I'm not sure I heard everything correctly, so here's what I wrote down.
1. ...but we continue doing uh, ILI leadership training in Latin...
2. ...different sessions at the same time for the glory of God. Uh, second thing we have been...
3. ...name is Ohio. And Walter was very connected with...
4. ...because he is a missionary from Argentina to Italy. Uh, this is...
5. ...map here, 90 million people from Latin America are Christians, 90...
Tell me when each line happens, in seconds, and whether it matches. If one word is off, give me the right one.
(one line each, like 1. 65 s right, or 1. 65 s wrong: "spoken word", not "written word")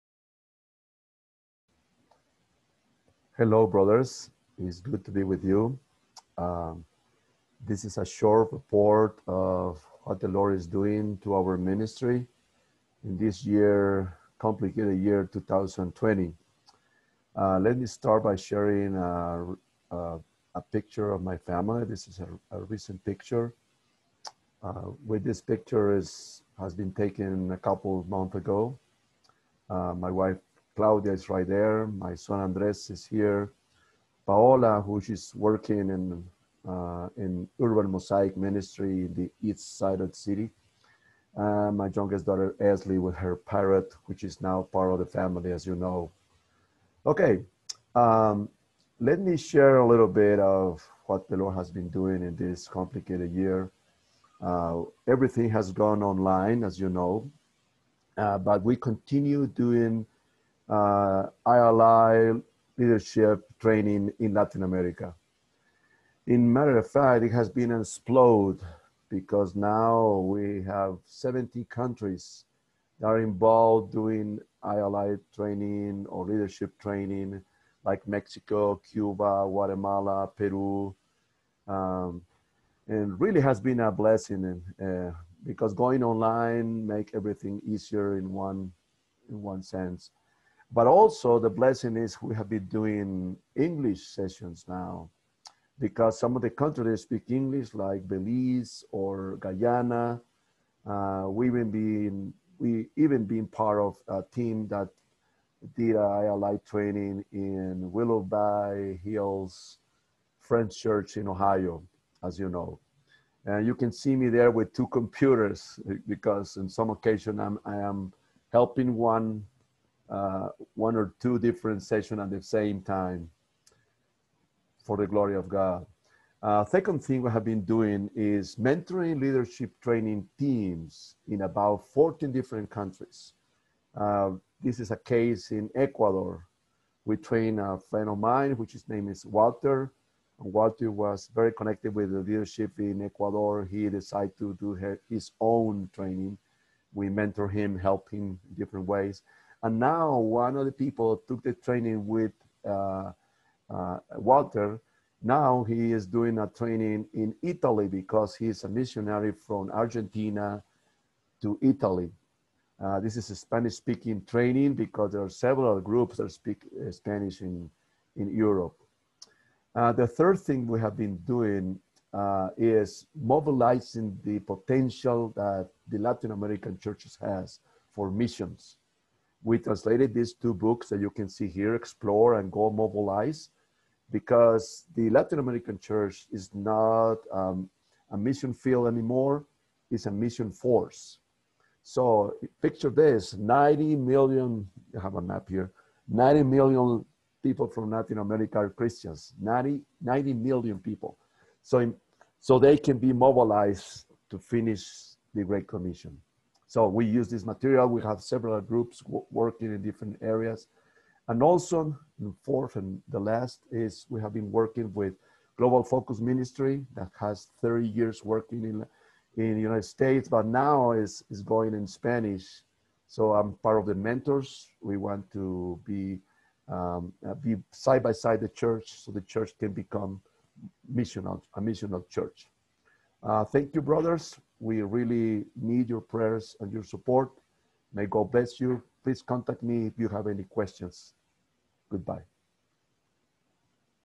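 1. 58 s right
2. 121 s right
3. 138 s wrong: "Walter", not "Ohio"
4. 157 s right
5. 195 s right.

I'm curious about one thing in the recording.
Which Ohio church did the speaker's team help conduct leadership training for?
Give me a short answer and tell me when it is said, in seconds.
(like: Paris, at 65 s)
Willoughby Hills Friends Church, at 107 s.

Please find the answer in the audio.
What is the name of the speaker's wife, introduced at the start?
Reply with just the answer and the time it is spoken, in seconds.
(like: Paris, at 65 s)
Claudia, at 30 s.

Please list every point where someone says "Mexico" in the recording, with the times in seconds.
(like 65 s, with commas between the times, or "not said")
78 s.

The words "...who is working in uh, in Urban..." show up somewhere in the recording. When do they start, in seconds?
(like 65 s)
34 s.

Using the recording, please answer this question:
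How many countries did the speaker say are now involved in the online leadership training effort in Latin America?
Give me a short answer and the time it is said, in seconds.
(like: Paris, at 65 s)
70, at 71 s.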